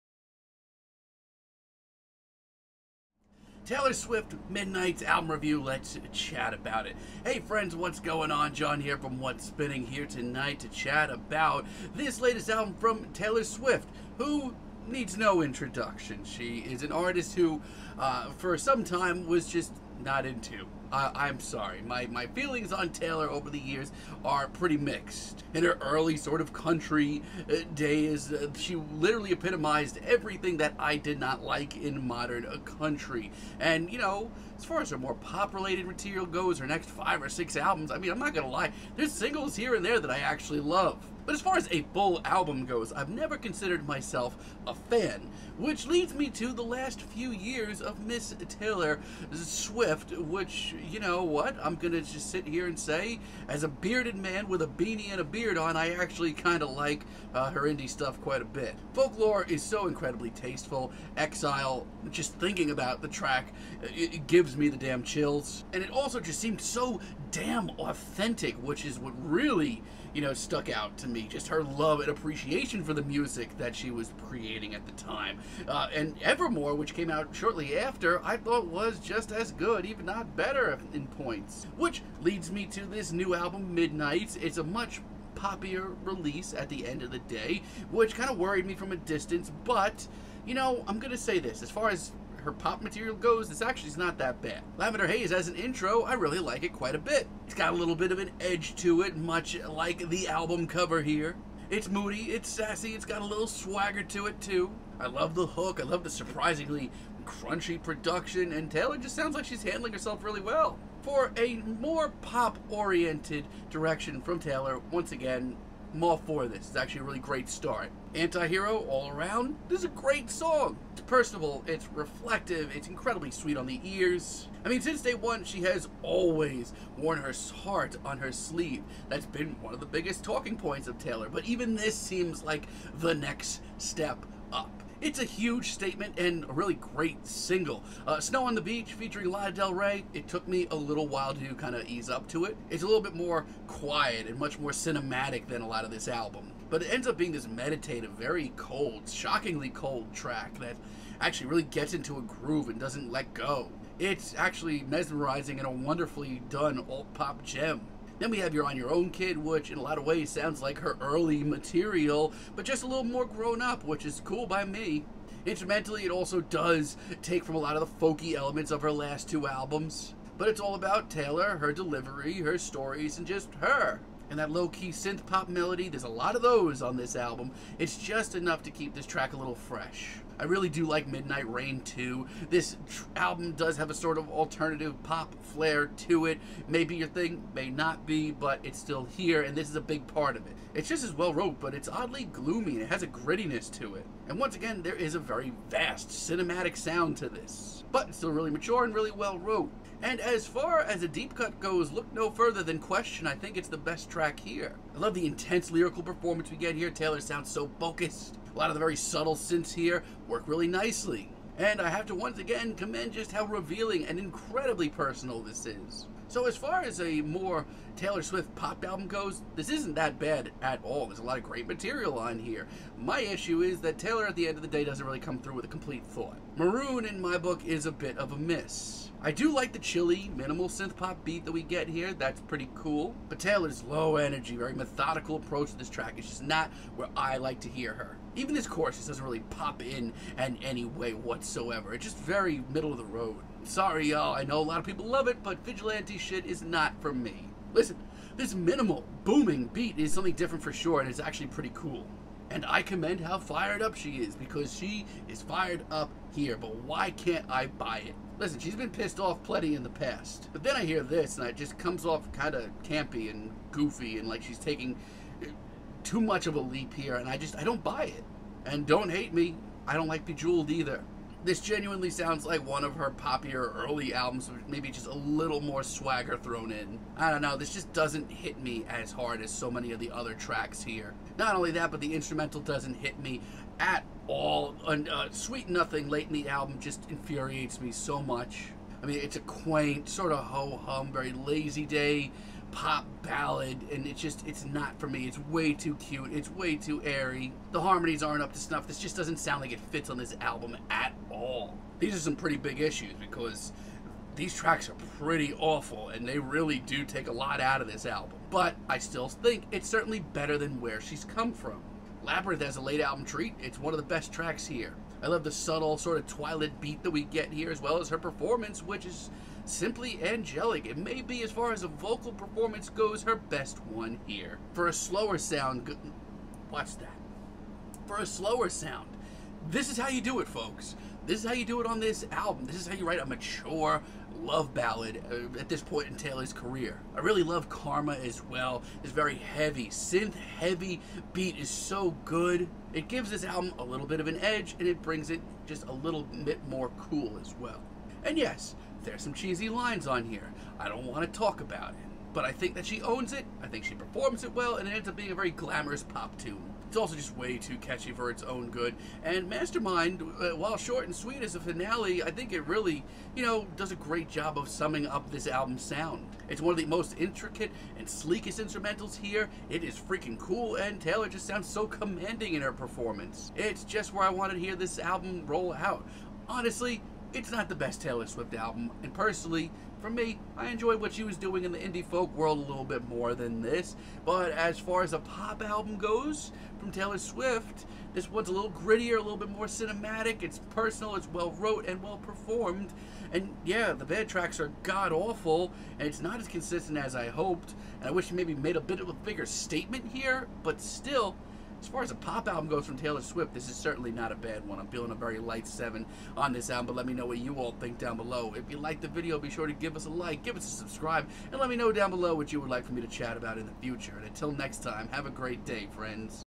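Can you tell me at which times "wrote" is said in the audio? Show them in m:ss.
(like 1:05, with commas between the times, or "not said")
3:11, 3:19, 6:31.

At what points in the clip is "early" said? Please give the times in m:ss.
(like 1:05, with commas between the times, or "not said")
0:25, 2:41, 4:33.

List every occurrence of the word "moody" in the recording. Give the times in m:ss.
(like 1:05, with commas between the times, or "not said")
1:41.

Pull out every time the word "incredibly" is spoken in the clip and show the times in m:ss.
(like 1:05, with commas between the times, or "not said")
0:59, 2:02, 3:34.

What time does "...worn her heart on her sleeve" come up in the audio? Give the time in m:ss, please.
2:06.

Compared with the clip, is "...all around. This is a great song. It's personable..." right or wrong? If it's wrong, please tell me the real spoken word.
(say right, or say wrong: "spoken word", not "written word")
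right.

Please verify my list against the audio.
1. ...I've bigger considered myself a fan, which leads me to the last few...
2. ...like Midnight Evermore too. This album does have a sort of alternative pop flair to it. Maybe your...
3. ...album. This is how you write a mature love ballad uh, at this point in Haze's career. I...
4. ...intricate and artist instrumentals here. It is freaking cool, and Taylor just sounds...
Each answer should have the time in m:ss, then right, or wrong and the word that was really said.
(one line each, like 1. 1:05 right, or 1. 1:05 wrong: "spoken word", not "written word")
1. 0:42 wrong: "never", not "bigger"
2. 3:00 wrong: "Rain", not "Evermore"
3. 5:32 wrong: "Taylor", not "Haze"
4. 6:07 wrong: "sleekest", not "artist".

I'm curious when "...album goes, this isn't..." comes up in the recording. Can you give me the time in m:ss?
3:38.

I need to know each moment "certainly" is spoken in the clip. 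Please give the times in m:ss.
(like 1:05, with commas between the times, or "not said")
5:09, 6:43.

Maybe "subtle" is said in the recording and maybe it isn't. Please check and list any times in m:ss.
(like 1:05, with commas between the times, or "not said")
3:28, 5:15.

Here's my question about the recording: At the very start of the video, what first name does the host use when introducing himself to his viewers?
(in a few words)
John.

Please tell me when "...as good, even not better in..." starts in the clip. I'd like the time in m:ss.
1:19.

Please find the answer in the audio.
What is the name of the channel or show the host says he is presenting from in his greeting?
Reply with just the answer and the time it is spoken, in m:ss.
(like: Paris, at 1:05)
What's Spinning, at 0:09.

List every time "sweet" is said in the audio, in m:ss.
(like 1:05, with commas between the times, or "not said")
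2:03, 4:45, 6:01.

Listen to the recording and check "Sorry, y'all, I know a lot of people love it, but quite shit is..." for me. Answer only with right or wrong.
wrong.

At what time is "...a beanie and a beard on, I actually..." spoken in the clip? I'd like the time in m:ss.
0:54.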